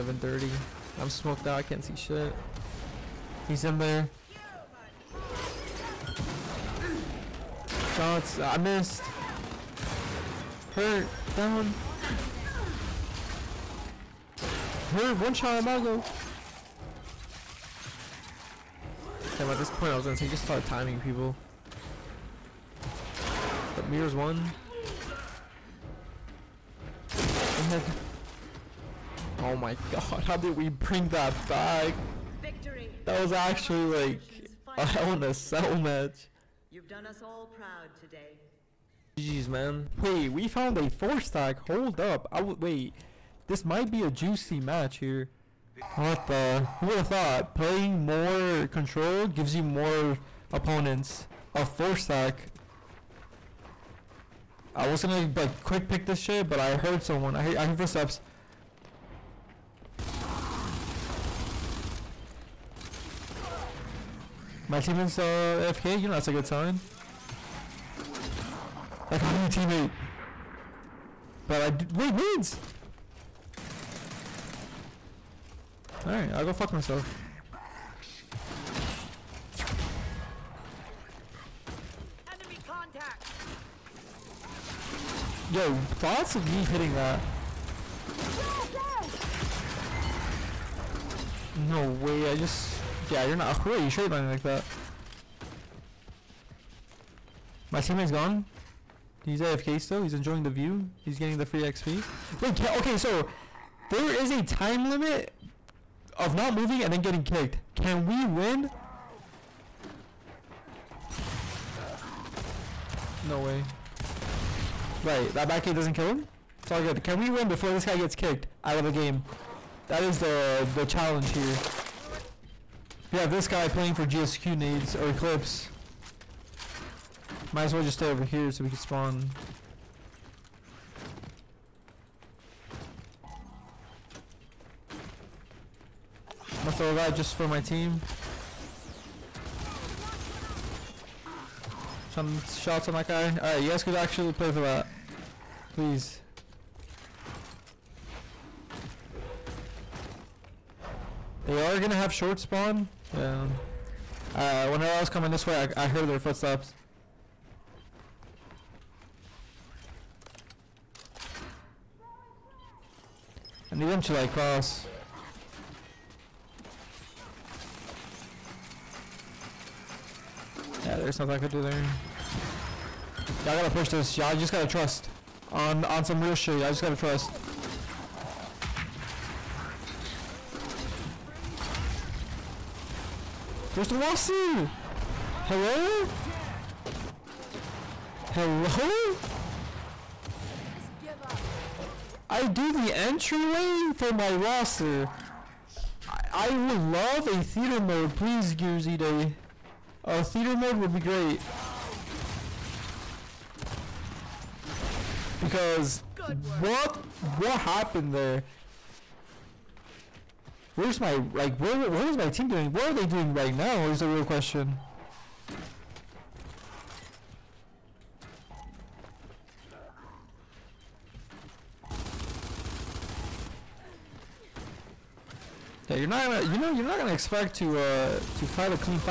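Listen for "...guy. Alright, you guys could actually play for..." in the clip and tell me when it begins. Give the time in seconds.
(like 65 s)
143 s.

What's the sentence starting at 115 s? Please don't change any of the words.
Right, that back eight doesn't kill him.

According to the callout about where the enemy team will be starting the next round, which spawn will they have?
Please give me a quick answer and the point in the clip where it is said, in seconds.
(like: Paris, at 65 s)
short spawn, at 152 s.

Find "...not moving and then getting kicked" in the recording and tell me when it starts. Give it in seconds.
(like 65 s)
106 s.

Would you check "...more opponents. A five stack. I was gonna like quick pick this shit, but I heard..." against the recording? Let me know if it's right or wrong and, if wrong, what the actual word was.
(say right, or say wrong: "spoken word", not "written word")
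wrong: "four", not "five".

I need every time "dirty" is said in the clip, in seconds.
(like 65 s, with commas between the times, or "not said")
0 s.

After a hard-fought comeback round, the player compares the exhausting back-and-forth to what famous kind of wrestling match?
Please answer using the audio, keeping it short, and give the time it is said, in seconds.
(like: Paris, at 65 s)
Hell in a Cell, at 34 s.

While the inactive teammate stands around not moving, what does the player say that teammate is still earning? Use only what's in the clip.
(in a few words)
free XP.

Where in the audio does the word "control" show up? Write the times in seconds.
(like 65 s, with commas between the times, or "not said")
48 s.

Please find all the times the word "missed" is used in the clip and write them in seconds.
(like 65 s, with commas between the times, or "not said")
8 s.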